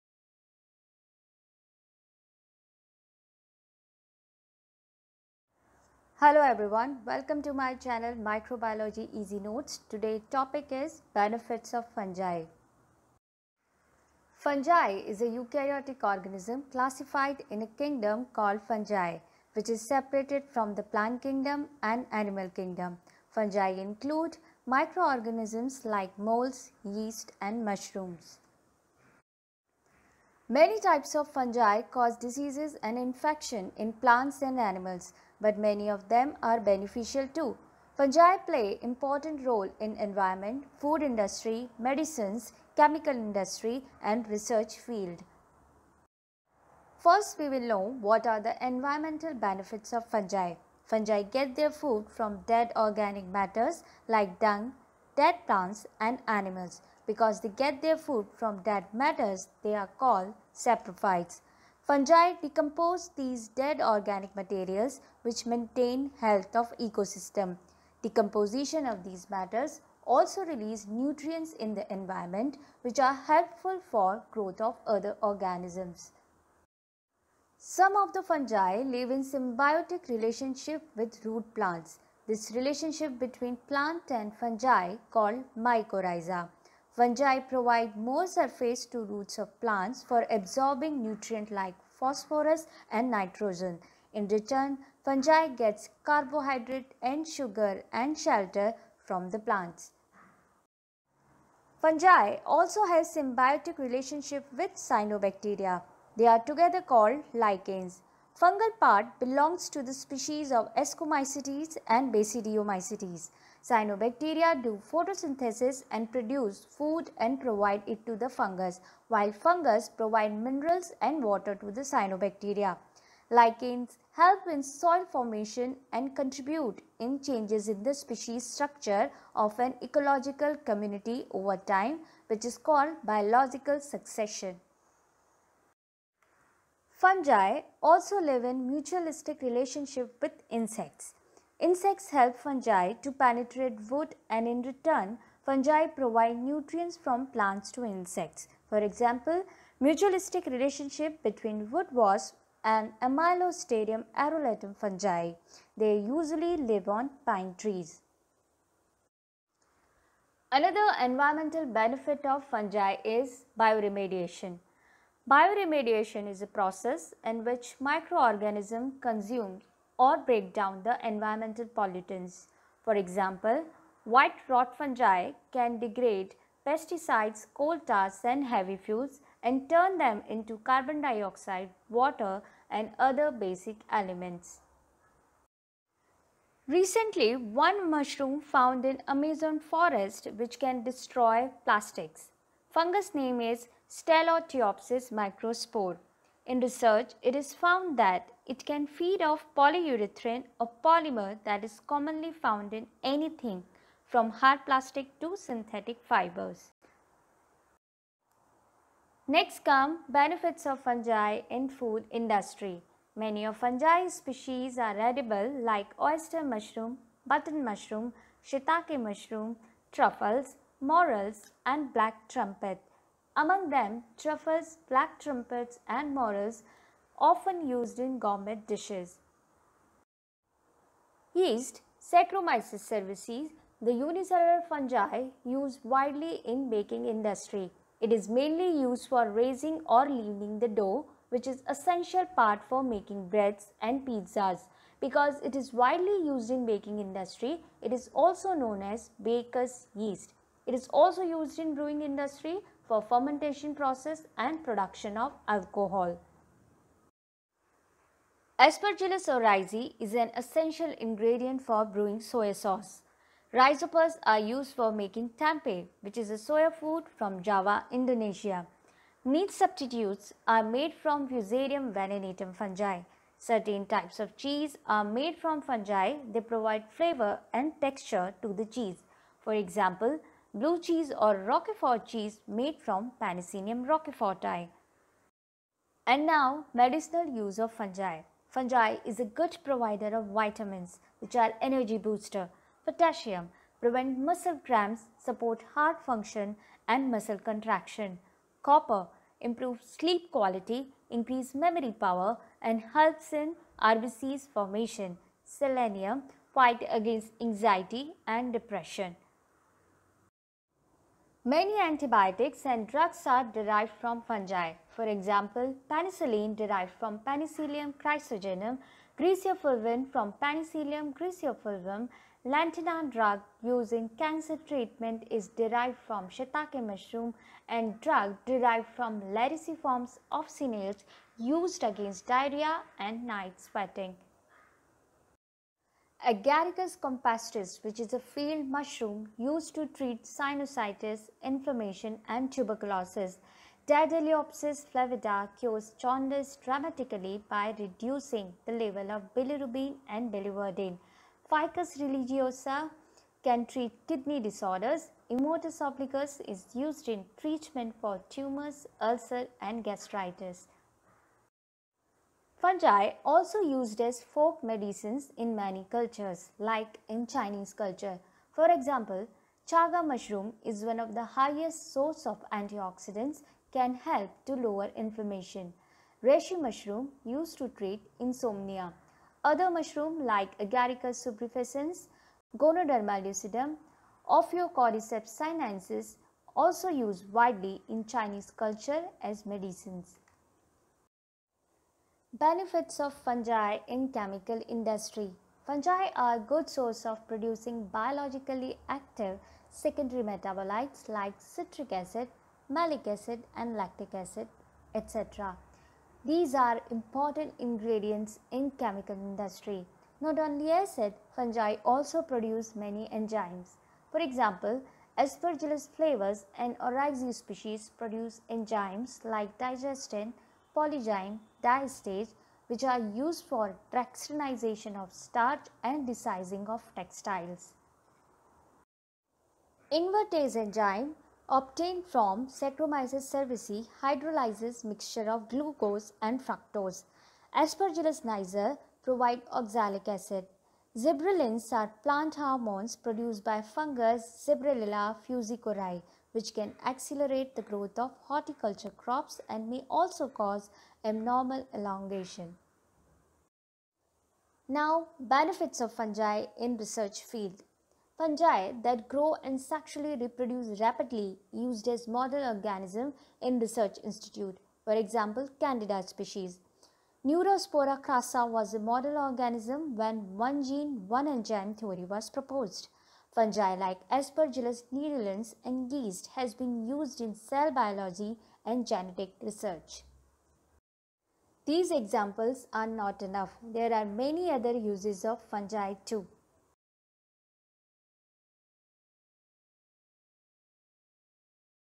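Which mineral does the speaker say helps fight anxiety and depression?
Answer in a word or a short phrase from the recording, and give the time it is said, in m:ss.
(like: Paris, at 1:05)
Selenium, at 5:05.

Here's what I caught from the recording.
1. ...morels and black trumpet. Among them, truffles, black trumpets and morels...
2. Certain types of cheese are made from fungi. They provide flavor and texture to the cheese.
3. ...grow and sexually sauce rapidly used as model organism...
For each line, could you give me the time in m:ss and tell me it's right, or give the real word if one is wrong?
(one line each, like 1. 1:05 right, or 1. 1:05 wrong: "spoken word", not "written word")
1. 3:40 right
2. 4:33 right
3. 7:39 wrong: "reproduce", not "sauce".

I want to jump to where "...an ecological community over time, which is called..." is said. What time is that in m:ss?
2:09.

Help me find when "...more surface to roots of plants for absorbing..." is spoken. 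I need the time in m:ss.
1:27.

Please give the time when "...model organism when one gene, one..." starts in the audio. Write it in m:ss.
7:48.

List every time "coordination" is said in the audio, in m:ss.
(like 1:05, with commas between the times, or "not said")
not said.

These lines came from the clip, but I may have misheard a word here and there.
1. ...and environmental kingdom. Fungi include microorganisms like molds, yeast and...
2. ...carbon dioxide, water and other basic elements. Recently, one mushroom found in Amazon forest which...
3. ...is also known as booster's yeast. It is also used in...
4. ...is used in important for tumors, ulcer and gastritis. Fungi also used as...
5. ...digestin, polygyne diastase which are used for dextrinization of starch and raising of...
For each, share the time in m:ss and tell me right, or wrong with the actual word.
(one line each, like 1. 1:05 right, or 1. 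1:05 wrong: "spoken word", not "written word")
1. 0:21 wrong: "animal", not "environmental"
2. 3:00 right
3. 4:07 wrong: "baker", not "booster"
4. 5:56 wrong: "treatment", not "important"
5. 6:59 wrong: "desizing", not "raising".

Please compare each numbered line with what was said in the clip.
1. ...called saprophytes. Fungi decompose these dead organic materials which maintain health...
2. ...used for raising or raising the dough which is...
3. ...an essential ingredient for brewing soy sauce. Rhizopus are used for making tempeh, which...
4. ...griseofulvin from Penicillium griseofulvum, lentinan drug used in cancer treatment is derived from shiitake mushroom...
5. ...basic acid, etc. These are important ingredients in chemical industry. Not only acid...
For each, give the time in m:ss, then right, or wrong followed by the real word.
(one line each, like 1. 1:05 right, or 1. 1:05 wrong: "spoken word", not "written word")
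1. 0:59 right
2. 3:58 wrong: "leavening", not "raising"
3. 4:20 right
4. 5:19 right
5. 6:43 wrong: "lactic", not "basic".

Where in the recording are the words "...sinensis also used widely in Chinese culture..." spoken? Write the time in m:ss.
6:25.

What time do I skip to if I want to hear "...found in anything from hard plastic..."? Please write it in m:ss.
3:22.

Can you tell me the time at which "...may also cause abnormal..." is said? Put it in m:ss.
7:29.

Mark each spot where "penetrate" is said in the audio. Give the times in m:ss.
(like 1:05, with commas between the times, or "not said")
2:23.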